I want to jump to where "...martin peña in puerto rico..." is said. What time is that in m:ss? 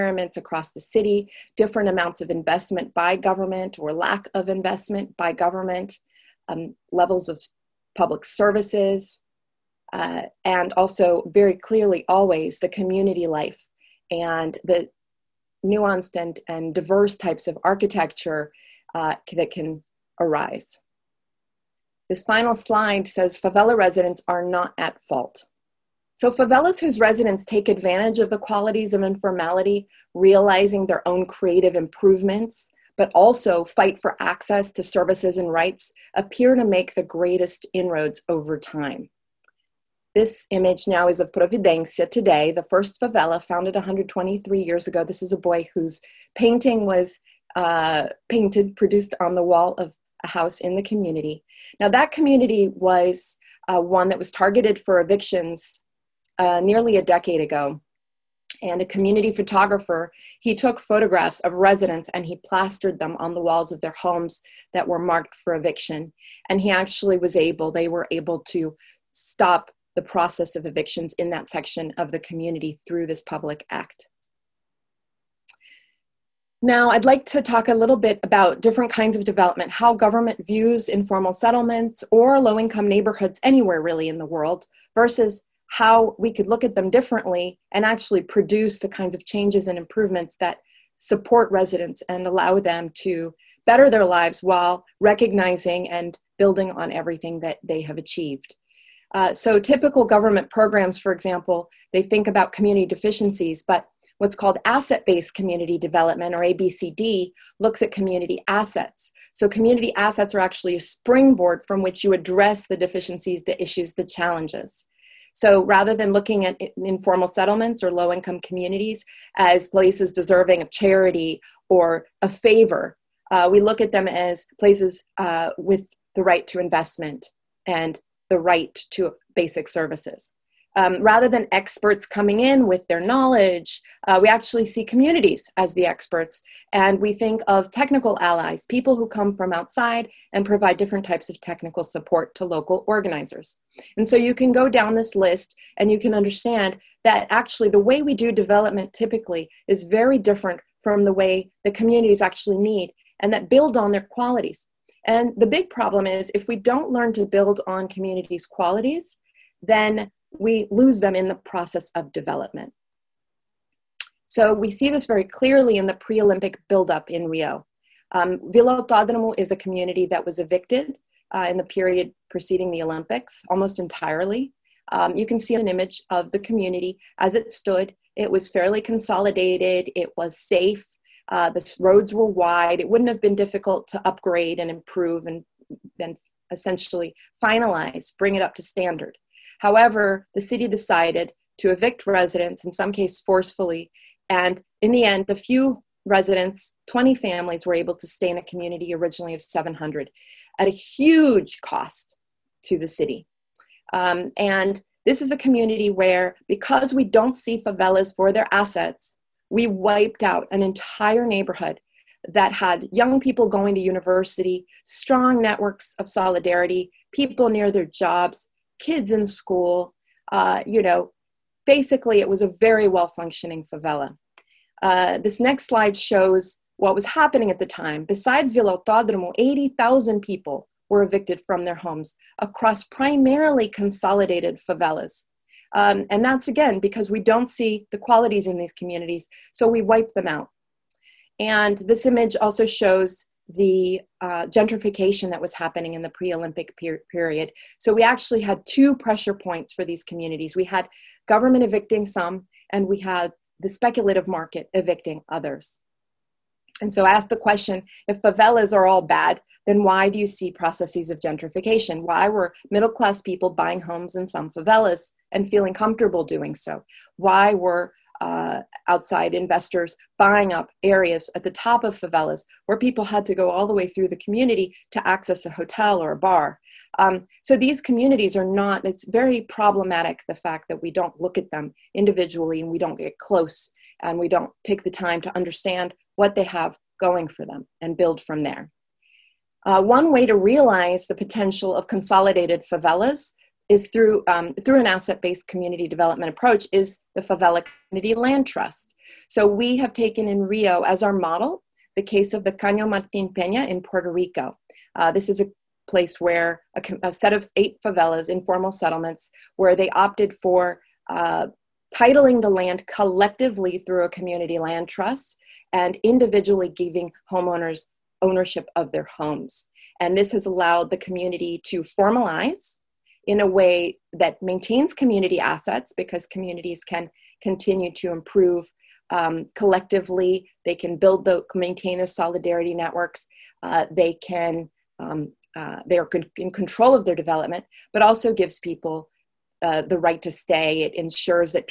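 5:02.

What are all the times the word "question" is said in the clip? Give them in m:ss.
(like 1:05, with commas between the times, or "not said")
4:17.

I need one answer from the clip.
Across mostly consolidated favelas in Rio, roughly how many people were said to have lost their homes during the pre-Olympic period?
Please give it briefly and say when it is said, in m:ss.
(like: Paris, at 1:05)
80,000, at 3:49.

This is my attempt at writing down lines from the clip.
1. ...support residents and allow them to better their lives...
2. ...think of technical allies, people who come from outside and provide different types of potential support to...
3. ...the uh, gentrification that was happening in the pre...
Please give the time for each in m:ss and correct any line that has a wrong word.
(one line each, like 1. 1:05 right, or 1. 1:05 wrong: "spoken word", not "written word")
1. 1:30 right
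2. 2:17 wrong: "technical", not "potential"
3. 4:03 right.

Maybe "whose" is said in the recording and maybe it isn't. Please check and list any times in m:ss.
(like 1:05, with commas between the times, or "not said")
0:26, 0:45.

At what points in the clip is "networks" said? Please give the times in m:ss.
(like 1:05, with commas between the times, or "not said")
3:35, 5:32.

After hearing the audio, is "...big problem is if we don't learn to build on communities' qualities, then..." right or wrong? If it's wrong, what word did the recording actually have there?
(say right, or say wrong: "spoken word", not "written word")
right.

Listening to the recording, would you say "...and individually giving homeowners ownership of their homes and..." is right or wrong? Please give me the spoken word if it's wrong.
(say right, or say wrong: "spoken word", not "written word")
right.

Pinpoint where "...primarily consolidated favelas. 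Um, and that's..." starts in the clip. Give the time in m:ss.
3:52.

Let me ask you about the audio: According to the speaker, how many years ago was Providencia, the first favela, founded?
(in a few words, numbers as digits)
123.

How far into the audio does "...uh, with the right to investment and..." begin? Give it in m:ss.
2:05.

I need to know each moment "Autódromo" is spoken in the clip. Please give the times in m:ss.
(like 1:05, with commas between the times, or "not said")
2:48, 3:48.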